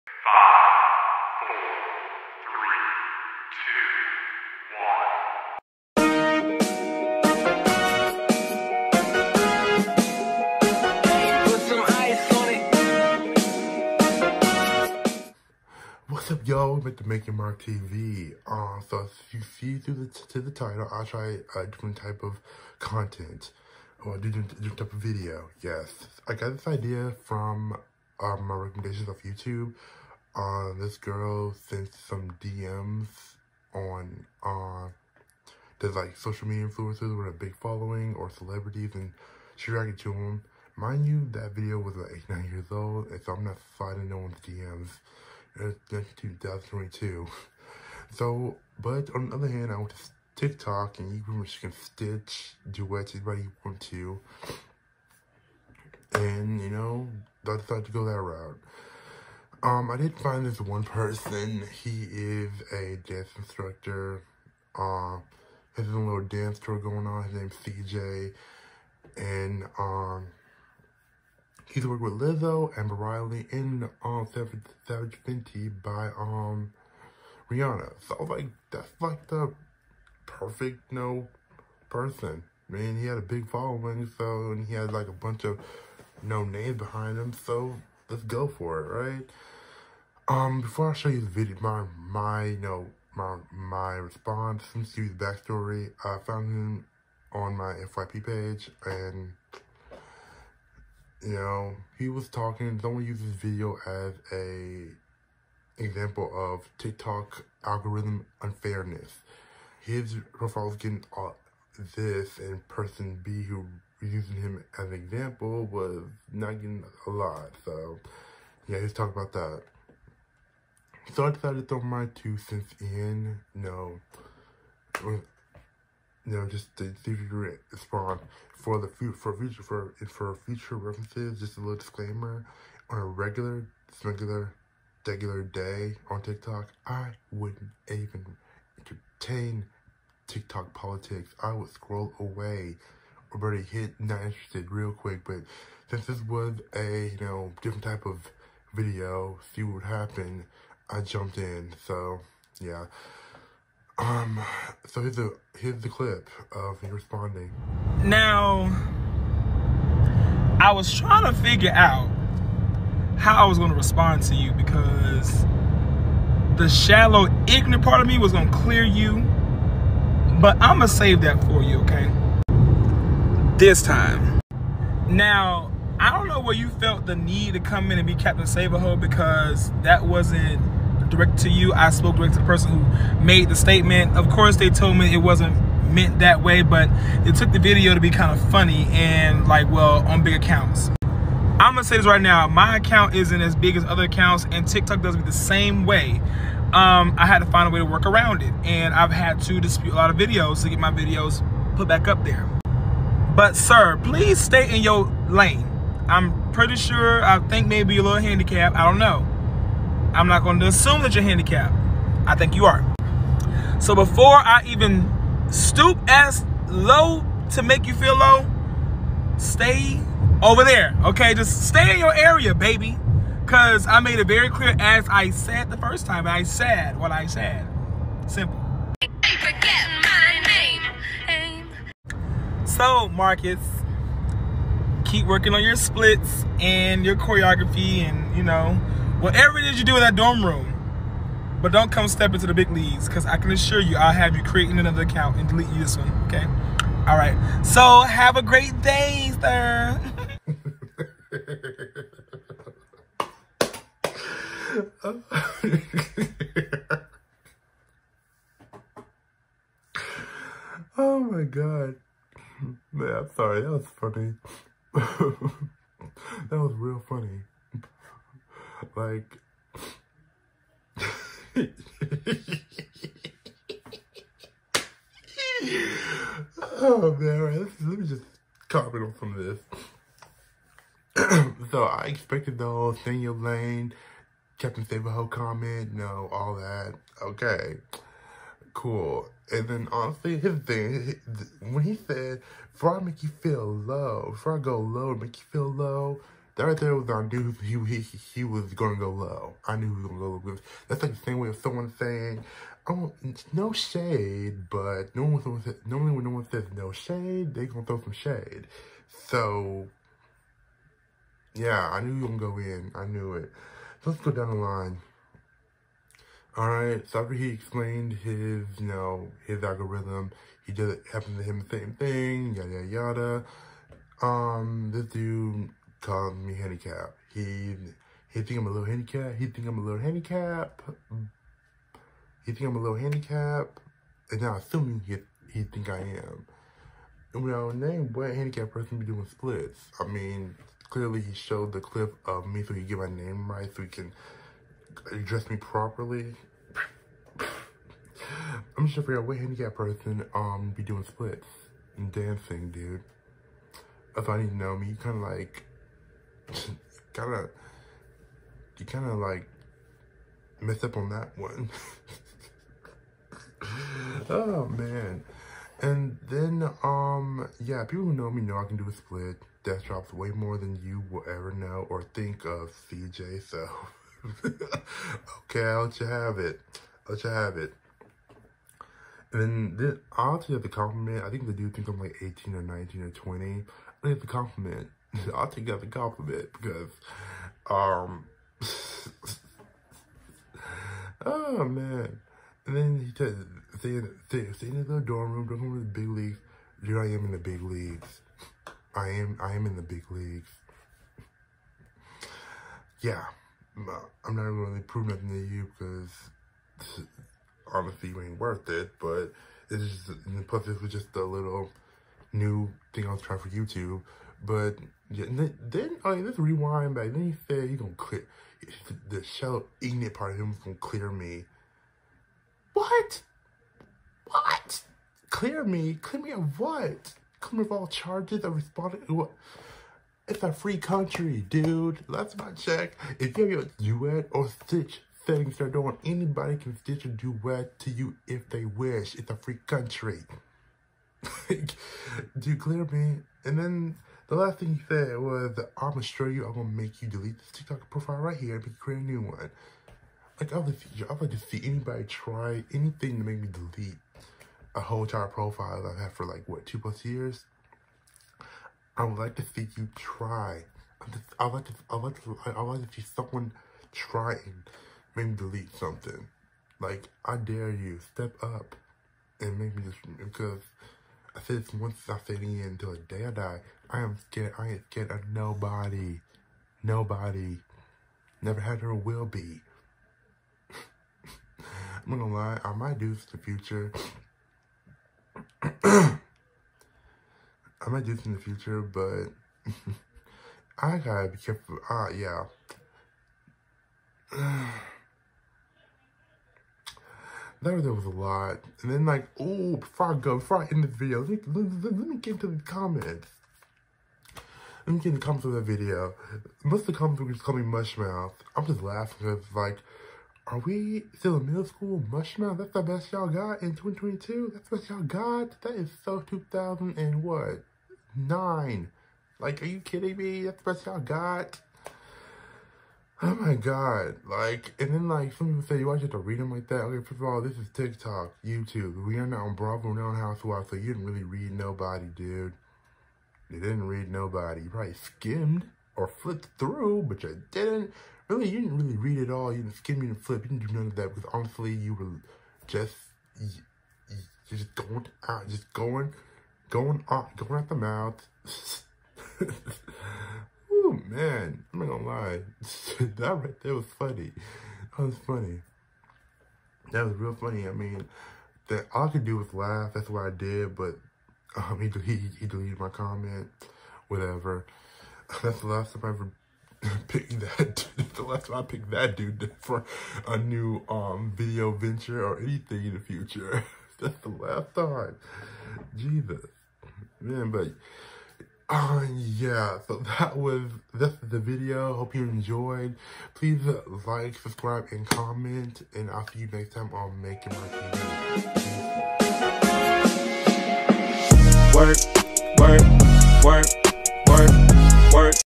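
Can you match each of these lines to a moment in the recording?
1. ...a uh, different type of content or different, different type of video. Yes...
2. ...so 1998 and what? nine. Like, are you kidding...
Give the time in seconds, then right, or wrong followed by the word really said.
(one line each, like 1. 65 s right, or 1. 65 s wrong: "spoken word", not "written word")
1. 21 s right
2. 516 s wrong: "2000", not "1998".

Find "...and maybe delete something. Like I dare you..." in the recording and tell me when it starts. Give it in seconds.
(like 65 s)
464 s.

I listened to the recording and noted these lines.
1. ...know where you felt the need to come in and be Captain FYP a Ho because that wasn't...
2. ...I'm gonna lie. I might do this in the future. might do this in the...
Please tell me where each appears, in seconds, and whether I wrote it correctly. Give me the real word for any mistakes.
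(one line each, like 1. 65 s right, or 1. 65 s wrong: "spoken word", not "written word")
1. 176 s wrong: "Save", not "FYP"
2. 481 s right.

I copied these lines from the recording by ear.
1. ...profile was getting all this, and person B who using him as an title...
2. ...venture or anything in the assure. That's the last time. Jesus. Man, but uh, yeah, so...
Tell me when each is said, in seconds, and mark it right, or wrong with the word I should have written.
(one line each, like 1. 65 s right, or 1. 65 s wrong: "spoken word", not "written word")
1. 110 s wrong: "example", not "title"
2. 571 s wrong: "future", not "assure".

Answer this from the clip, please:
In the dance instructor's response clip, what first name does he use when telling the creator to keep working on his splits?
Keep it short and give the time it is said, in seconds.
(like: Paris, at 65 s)
Marcus, at 233 s.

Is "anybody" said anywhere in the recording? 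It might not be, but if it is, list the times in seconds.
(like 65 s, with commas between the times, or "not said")
53 s, 436 s, 451 s.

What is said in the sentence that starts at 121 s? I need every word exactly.
So I decided to throw my two cents in.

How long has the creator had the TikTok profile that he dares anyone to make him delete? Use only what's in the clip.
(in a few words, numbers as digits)
Two plus years.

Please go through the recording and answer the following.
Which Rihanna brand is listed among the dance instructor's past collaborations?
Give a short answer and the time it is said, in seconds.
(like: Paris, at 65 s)
Savage Fenty, at 74 s.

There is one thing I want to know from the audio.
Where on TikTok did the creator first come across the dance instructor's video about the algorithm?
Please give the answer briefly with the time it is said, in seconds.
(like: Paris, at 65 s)
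FYP page, at 97 s.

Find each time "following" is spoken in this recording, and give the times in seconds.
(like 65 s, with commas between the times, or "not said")
37 s, 83 s.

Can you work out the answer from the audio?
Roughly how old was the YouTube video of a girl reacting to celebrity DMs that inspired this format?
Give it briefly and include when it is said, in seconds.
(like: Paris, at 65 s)
8, 9 years, at 42 s.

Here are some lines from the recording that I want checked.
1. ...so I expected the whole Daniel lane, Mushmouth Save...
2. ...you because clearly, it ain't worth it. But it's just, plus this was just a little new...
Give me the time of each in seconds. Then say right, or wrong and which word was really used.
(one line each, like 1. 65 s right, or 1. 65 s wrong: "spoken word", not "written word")
1. 281 s wrong: "Captain", not "Mushmouth"
2. 405 s wrong: "honestly", not "clearly".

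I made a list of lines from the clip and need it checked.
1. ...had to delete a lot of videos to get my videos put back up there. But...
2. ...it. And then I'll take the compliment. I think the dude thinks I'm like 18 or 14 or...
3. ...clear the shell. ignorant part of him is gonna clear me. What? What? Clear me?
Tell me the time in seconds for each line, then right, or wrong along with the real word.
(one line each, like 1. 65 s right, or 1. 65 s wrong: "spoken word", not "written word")
1. 199 s wrong: "dispute", not "delete"
2. 377 s wrong: "19", not "14"
3. 417 s right.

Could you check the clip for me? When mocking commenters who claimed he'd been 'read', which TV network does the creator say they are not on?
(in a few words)
Bravo.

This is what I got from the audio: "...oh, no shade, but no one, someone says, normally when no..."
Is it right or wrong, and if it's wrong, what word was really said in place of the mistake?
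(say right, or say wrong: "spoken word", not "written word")
right.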